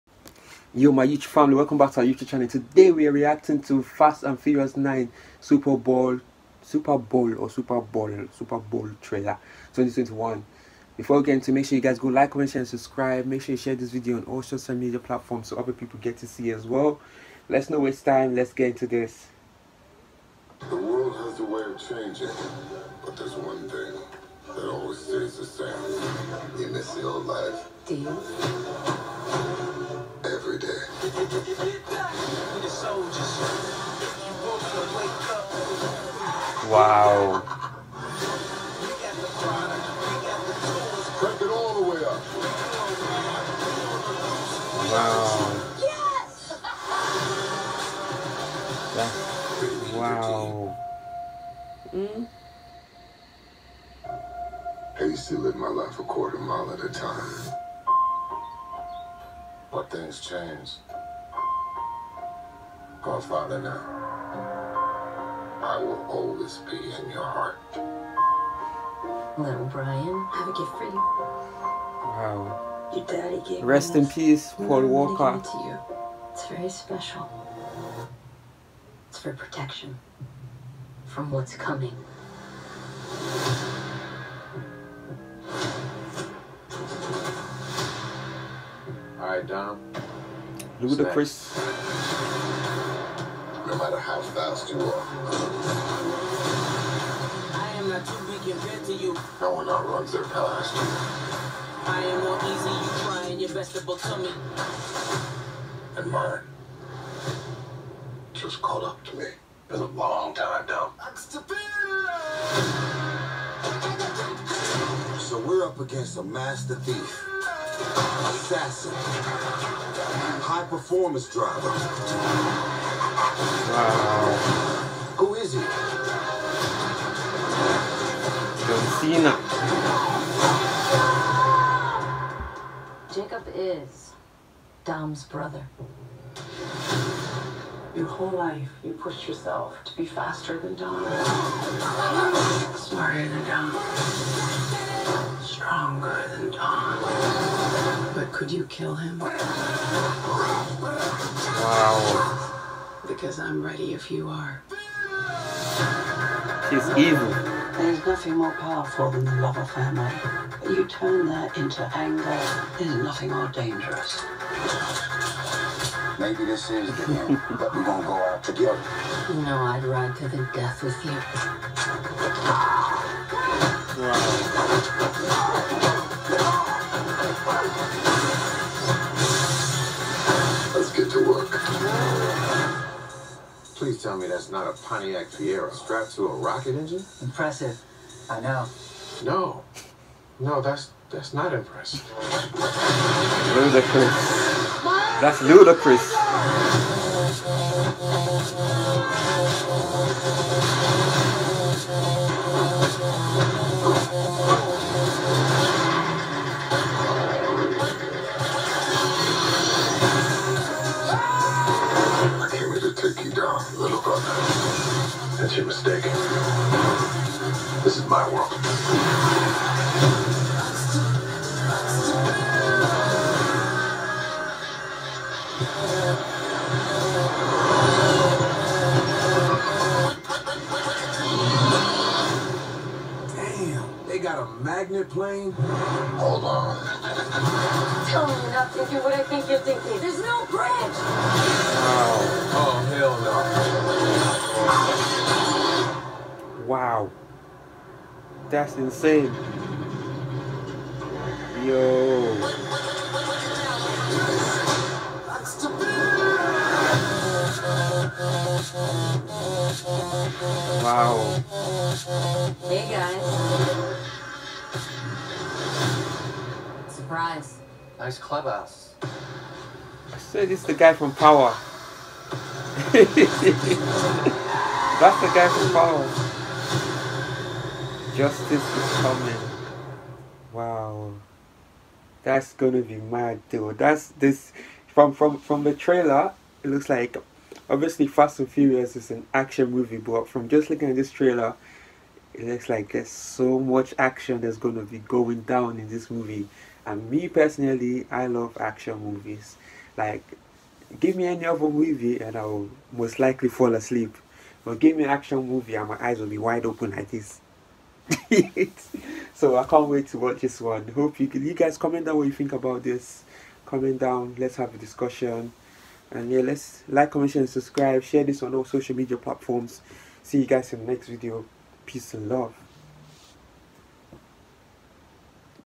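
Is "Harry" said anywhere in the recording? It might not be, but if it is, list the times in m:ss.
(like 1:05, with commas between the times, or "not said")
not said.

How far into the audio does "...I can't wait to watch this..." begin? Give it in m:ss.
5:09.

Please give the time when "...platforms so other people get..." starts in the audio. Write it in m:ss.
0:14.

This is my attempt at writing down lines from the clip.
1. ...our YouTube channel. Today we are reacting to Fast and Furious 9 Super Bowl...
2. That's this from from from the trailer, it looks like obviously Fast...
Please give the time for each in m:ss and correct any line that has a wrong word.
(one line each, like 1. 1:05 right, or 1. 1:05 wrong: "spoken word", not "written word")
1. 0:01 right
2. 4:43 right.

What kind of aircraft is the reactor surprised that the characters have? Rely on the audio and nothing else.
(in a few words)
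magnet plane.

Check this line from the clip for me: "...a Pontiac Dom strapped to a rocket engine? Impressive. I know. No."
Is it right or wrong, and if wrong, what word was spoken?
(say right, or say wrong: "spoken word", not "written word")
wrong: "Fiero", not "Dom".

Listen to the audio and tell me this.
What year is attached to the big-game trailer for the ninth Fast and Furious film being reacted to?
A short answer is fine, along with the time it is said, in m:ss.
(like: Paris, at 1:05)
2021, at 0:09.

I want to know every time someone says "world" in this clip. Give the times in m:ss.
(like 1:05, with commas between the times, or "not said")
0:20, 3:38.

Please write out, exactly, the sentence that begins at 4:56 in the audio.
And me personally, I love action movies.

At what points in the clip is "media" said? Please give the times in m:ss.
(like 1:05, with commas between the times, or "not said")
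0:14, 5:18.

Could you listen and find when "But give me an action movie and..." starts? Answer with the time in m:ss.
5:04.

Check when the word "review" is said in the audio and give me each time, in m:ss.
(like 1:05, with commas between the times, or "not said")
not said.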